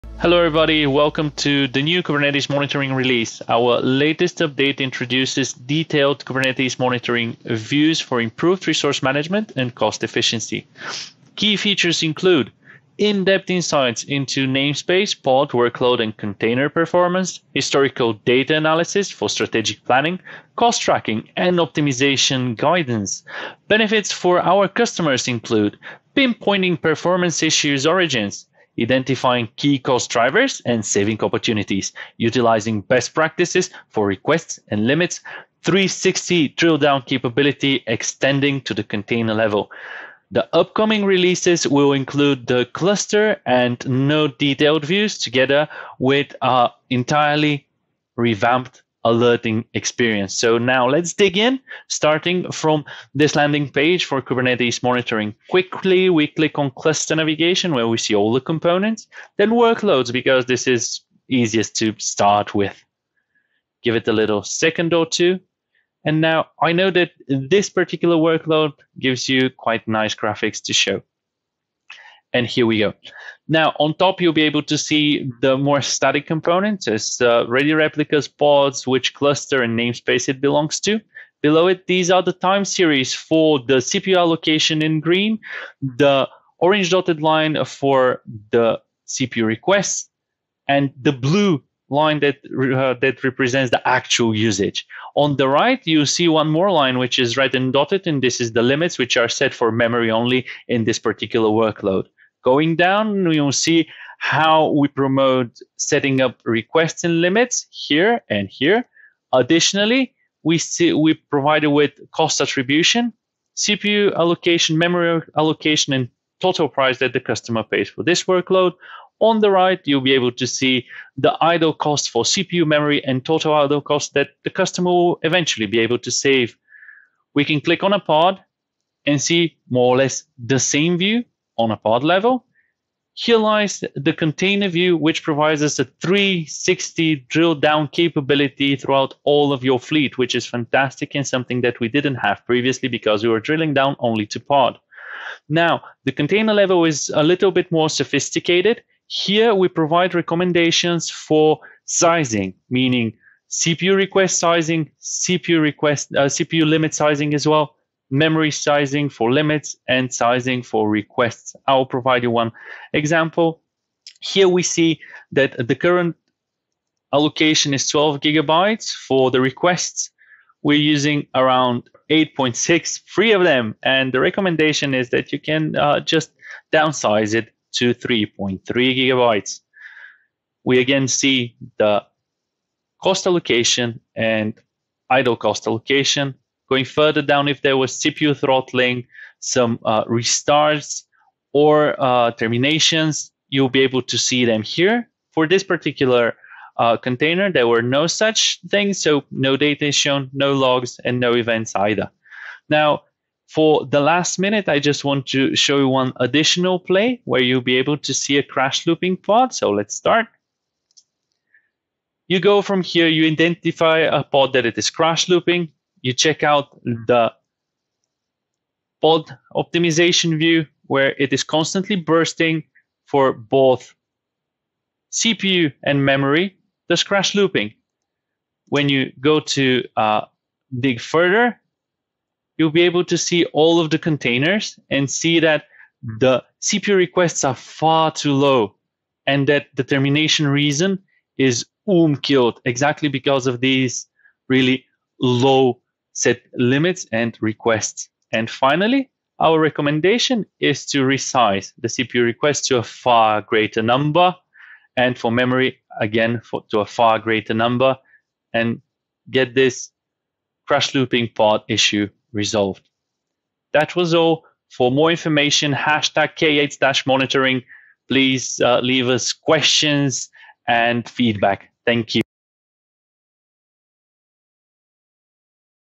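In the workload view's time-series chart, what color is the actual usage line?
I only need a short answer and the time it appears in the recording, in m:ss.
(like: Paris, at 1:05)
Blue, at 1:31.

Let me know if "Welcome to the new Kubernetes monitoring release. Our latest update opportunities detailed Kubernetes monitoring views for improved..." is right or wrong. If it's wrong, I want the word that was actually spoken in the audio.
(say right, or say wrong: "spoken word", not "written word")
wrong: "introduces", not "opportunities".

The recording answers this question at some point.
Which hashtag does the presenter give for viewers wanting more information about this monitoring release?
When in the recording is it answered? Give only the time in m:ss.
4:25.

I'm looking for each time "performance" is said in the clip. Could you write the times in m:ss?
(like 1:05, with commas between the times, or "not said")
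0:16, 0:26.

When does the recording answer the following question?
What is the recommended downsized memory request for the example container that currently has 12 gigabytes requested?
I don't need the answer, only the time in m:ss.
2:57.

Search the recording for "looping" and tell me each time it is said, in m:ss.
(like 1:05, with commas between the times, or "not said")
3:28, 3:35, 3:47, 4:20.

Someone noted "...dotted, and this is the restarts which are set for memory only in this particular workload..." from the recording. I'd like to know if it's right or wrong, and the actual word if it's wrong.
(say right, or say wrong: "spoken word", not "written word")
wrong: "limits", not "restarts".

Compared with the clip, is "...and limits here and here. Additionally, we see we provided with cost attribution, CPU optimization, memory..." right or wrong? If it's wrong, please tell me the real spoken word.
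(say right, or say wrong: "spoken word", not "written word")
wrong: "allocation", not "optimization".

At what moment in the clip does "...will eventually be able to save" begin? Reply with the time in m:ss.
2:04.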